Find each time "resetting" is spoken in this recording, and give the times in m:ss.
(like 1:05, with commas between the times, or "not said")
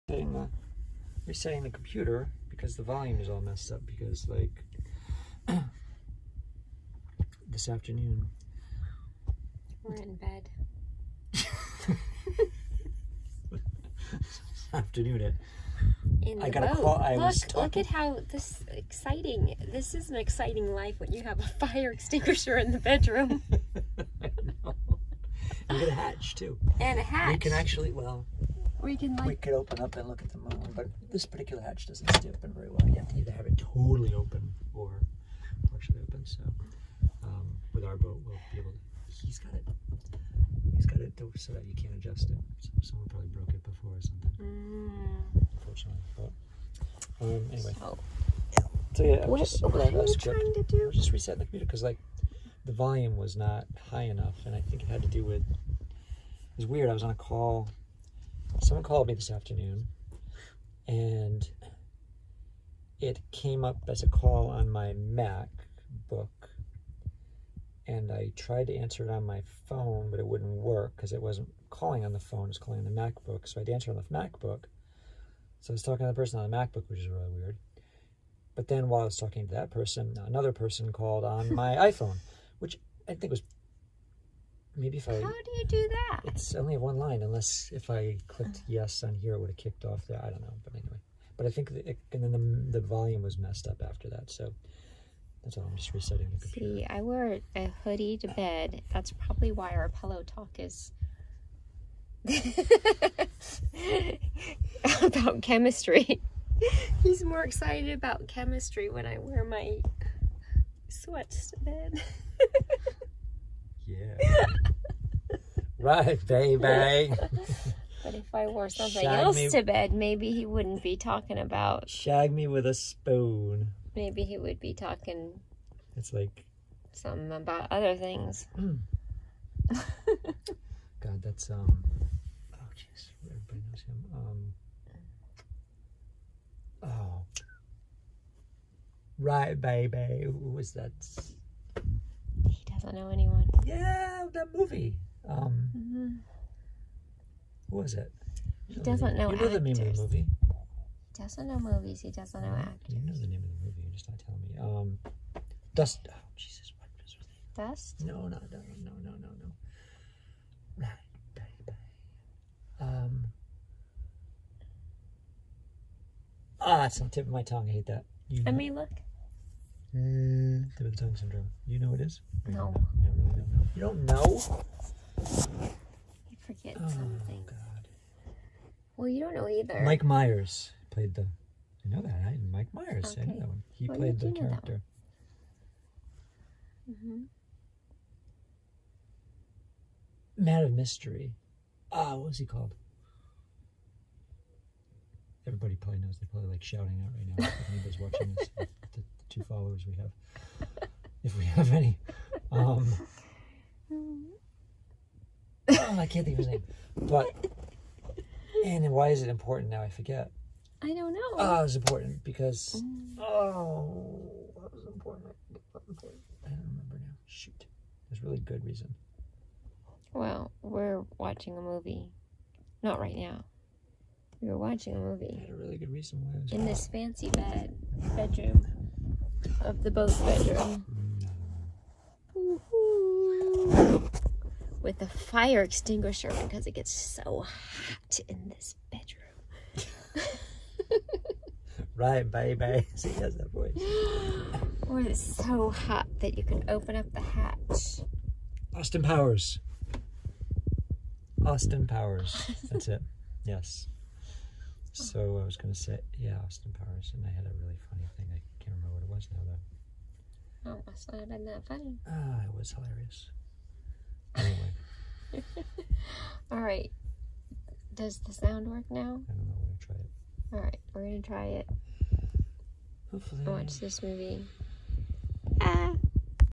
0:01, 0:51, 1:35.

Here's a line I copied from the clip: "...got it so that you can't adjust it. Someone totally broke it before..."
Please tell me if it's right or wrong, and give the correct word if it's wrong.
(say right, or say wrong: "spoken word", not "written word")
wrong: "probably", not "totally".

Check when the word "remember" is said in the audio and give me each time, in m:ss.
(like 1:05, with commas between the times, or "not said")
3:36, 4:18.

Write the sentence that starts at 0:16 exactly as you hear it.
I look, look at how this exciting.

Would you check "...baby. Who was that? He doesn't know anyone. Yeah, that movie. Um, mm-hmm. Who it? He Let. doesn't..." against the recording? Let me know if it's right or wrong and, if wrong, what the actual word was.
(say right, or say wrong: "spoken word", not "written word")
wrong: "Somebody", not "Let".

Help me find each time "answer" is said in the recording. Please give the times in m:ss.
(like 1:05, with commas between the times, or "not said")
1:08, 1:13.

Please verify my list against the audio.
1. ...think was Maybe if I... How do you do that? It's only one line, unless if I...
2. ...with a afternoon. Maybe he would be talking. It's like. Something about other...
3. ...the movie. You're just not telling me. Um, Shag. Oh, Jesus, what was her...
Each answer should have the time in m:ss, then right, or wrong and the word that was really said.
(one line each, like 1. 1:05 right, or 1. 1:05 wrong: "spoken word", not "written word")
1. 1:23 right
2. 2:02 wrong: "spoon", not "afternoon"
3. 2:33 wrong: "Dust", not "Shag".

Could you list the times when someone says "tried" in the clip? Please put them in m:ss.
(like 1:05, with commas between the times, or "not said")
1:08.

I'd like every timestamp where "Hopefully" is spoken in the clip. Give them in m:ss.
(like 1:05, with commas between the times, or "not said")
4:33.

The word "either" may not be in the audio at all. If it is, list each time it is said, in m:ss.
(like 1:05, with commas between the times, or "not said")
0:33, 2:59.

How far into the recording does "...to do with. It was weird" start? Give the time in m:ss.
0:55.